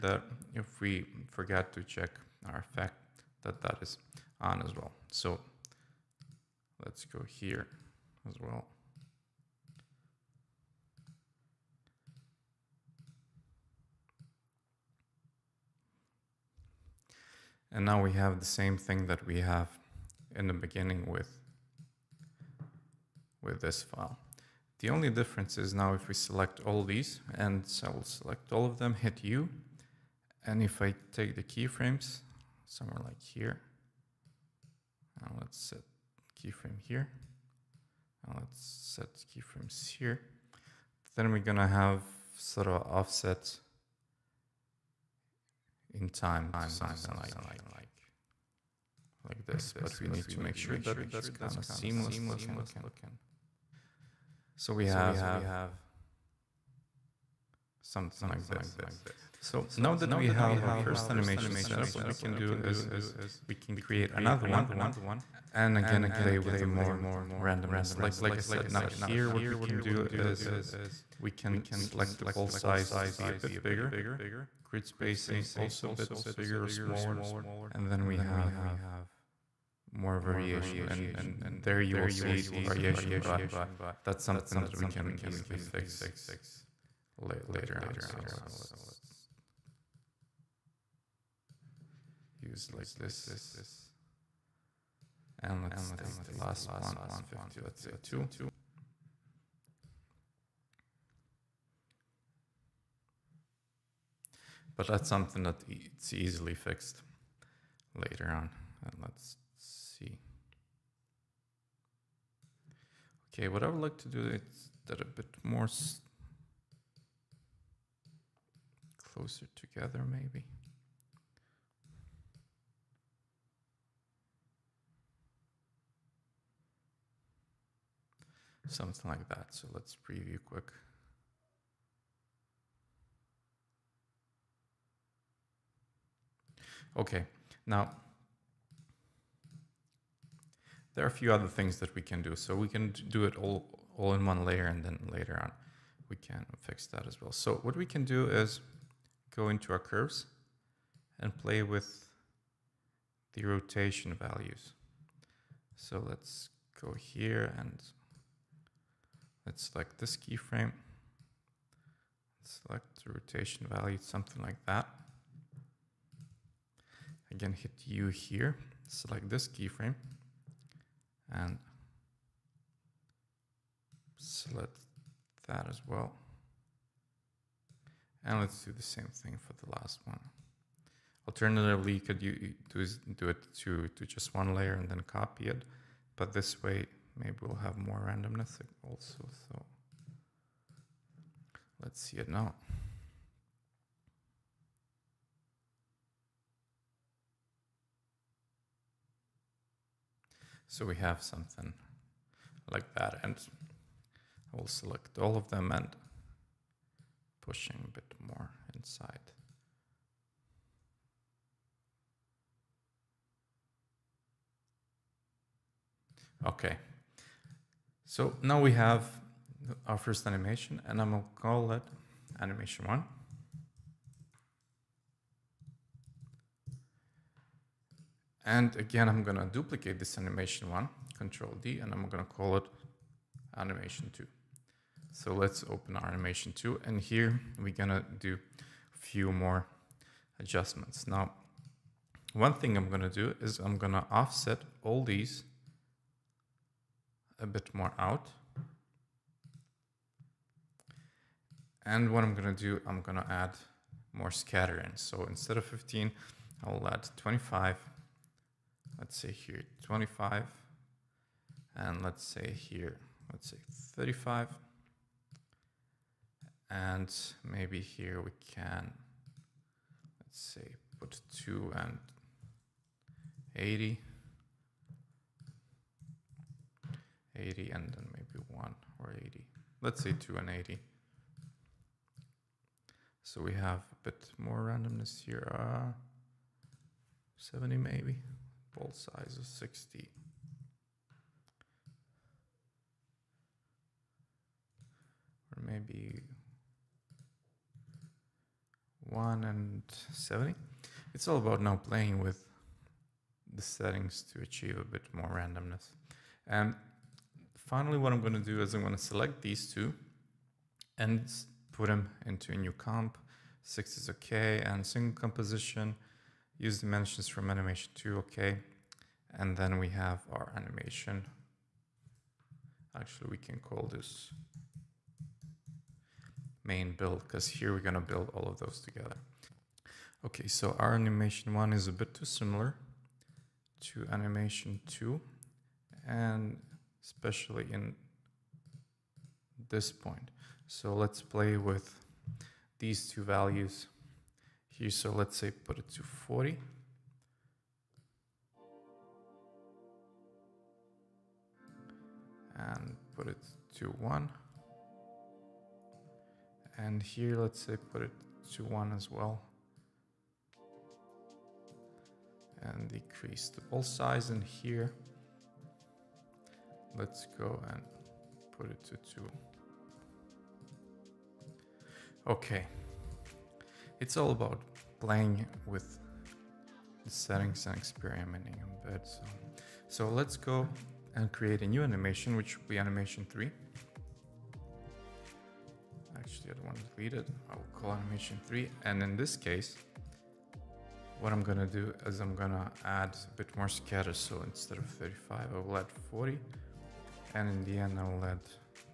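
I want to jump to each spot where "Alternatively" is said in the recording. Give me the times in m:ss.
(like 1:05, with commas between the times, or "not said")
3:01.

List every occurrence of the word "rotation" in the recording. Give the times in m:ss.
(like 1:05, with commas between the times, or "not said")
2:33, 2:43.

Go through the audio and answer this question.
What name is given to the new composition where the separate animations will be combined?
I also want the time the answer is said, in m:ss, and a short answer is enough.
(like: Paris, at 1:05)
main build, at 5:26.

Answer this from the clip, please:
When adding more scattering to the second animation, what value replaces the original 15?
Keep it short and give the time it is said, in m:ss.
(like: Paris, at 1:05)
25, at 4:15.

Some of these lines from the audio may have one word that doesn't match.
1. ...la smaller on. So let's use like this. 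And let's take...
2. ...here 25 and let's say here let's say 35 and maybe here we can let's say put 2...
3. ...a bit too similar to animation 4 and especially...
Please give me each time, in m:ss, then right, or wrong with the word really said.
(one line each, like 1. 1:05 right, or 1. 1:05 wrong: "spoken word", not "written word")
1. 1:27 wrong: "later", not "smaller"
2. 4:19 right
3. 5:31 wrong: "2", not "4".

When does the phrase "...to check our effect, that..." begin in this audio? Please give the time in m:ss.
0:01.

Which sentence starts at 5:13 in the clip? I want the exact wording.
6 is okay and single composition use dimensions from animation 2, okay.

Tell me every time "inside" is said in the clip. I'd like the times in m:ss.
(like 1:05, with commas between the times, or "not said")
3:28.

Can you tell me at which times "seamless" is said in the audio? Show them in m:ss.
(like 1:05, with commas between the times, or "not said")
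0:51.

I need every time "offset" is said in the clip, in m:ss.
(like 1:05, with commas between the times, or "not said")
0:42, 4:04.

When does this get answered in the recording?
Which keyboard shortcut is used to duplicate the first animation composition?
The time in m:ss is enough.
3:51.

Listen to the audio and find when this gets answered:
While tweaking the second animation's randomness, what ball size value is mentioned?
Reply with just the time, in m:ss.
4:48.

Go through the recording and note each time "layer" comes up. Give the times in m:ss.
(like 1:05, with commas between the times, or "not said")
2:24, 3:04.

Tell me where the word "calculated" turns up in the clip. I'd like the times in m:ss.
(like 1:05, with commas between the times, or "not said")
not said.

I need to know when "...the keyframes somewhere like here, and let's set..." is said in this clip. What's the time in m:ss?
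0:31.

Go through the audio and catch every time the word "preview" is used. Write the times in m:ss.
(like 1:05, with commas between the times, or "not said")
2:10.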